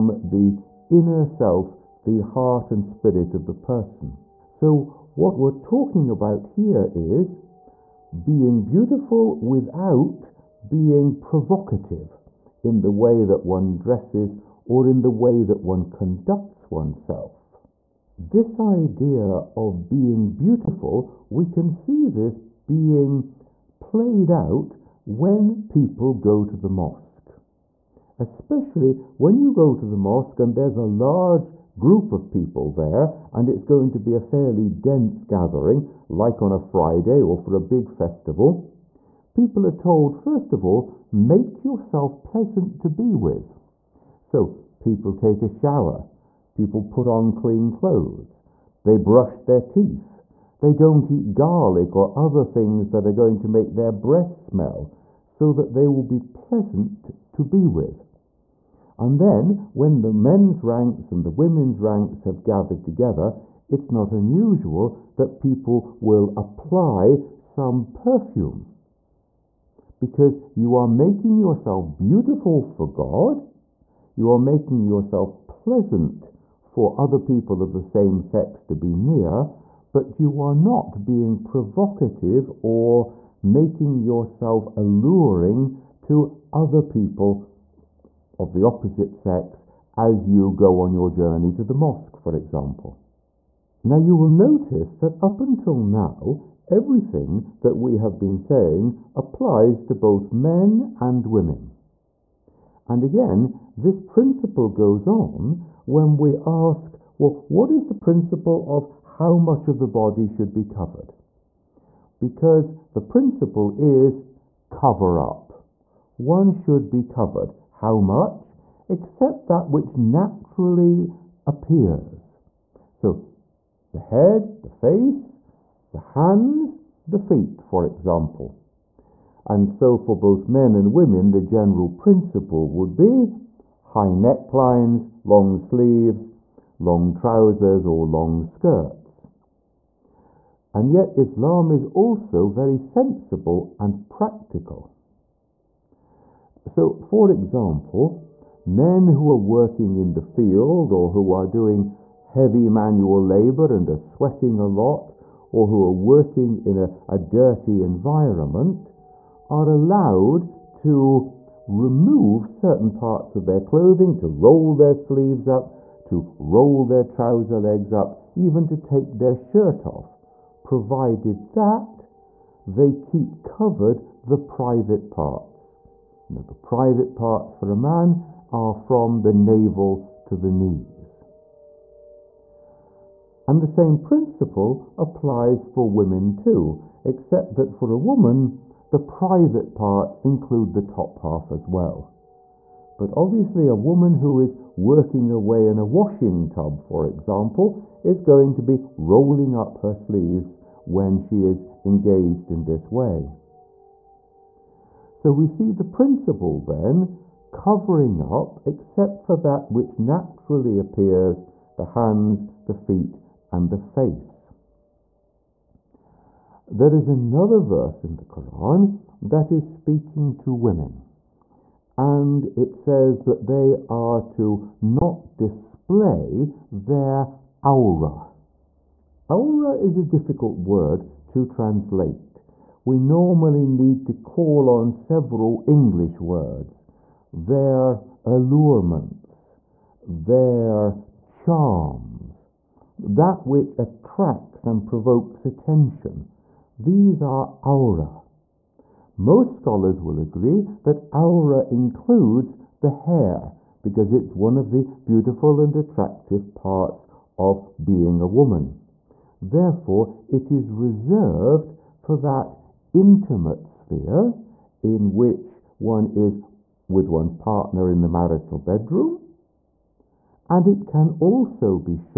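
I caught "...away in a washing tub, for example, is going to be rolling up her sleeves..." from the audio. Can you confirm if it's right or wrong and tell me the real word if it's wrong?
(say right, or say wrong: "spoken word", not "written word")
right.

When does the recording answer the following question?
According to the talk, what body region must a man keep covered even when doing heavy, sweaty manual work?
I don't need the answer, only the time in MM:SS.
02:58.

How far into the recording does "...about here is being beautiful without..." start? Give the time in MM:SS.
00:06.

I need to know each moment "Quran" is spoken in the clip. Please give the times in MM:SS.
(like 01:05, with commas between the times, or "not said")
03:38.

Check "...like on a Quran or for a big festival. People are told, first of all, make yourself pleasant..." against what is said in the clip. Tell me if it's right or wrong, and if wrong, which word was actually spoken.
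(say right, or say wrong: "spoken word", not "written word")
wrong: "Friday", not "Quran".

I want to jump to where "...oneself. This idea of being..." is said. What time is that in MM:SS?
00:16.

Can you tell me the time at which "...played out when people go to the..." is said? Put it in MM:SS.
00:23.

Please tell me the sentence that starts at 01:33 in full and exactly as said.
Now you will notice that up until now, everything that we have been saying applies to both men and women.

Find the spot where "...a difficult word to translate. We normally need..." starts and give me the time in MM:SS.
03:49.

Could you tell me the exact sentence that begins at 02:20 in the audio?
And yet Islam is also very sensible and practical.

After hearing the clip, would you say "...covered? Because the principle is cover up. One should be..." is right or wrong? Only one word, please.
right.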